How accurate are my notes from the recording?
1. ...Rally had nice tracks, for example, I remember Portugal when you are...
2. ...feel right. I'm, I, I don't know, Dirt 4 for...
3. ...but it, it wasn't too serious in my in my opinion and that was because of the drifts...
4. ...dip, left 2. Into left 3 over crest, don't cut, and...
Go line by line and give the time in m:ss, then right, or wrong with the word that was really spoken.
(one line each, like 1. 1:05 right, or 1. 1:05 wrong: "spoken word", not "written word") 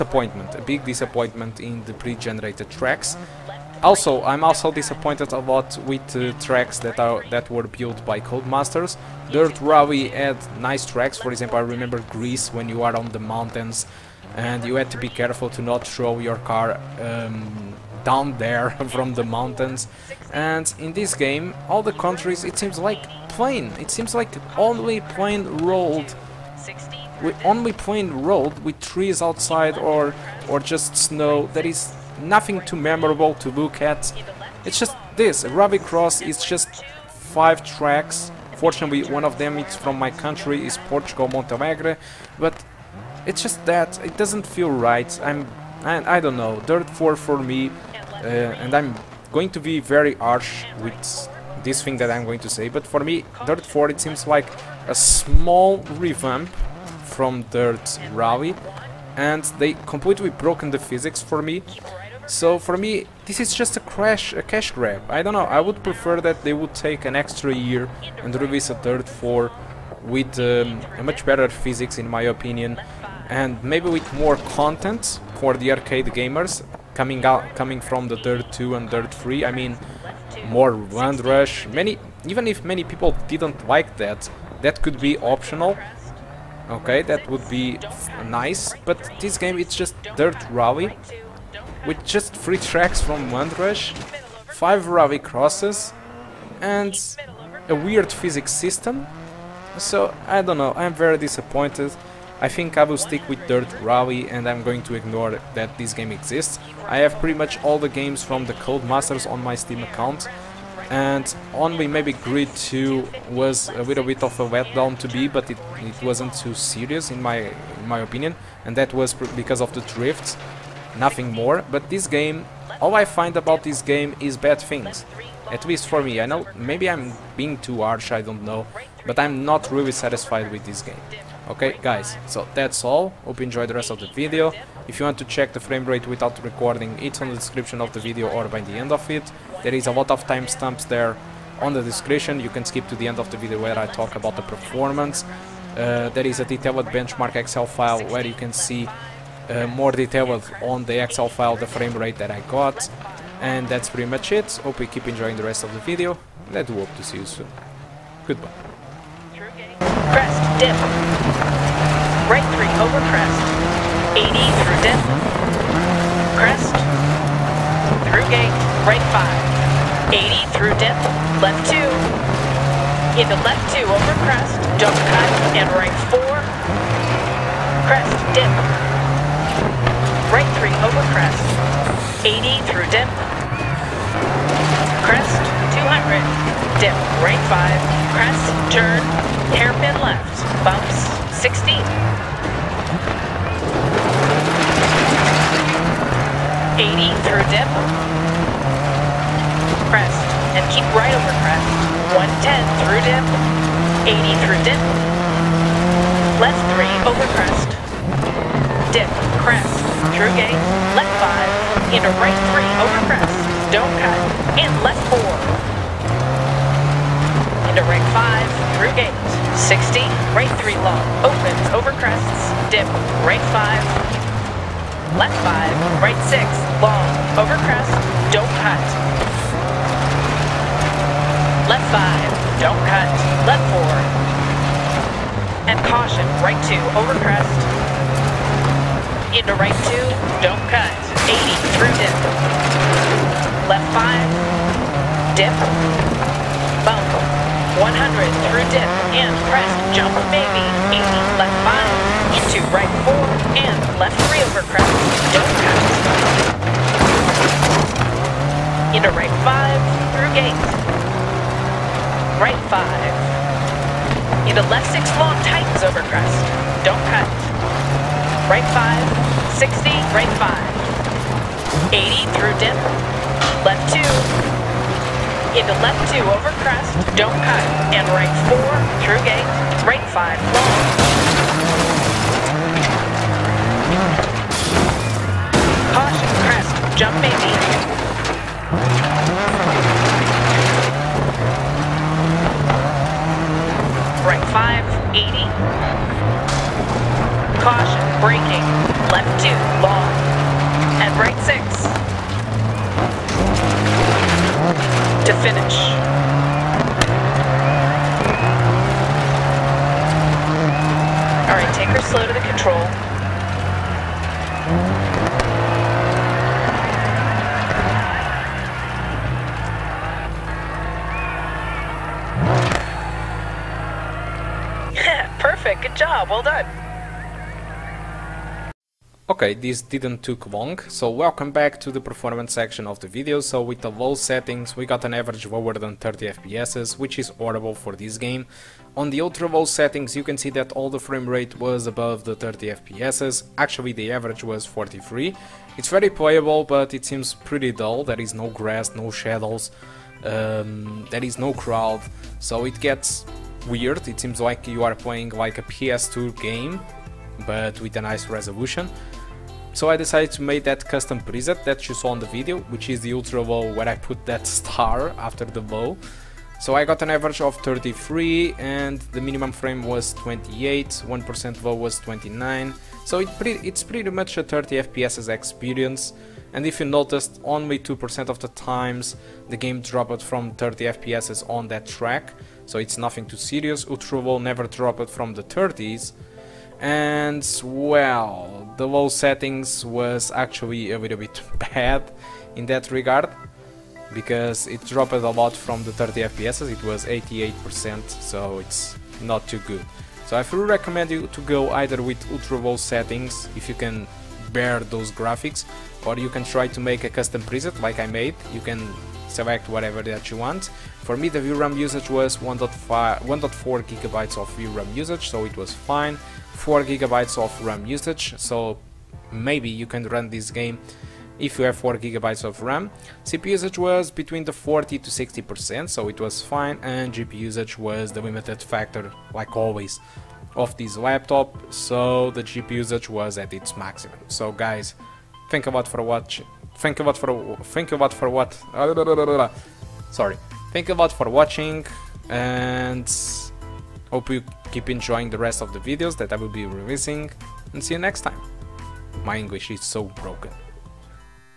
1. 0:09 wrong: "Greece", not "Portugal"
2. 0:44 right
3. 1:55 right
4. 2:50 wrong: "2", not "3".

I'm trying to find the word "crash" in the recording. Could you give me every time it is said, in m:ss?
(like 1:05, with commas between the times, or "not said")
1:03.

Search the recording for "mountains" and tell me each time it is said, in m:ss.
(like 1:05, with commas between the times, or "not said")
0:13, 0:19.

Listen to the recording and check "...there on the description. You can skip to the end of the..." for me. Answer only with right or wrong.
right.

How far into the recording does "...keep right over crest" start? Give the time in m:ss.
3:20.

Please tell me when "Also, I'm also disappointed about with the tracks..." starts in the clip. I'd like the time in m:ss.
0:03.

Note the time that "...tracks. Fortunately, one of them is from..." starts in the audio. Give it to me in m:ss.
0:37.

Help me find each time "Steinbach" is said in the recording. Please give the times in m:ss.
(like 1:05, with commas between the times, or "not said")
not said.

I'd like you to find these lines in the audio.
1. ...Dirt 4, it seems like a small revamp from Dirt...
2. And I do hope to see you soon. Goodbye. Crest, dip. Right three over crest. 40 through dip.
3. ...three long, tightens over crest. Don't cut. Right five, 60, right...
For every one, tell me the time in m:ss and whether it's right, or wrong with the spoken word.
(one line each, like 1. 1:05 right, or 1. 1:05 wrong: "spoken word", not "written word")
1. 0:53 right
2. 2:36 wrong: "80", not "40"
3. 4:24 wrong: "six", not "three".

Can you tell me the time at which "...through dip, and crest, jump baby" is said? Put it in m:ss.
4:08.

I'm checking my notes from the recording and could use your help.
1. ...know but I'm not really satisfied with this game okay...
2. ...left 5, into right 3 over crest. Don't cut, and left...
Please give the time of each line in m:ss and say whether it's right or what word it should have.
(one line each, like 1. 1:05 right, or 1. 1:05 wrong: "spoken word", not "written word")
1. 2:08 right
2. 3:30 right.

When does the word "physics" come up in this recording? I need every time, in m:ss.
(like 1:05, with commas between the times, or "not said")
1:00, 1:11, 1:38.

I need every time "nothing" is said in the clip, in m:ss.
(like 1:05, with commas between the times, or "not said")
0:32, 2:00, 6:22.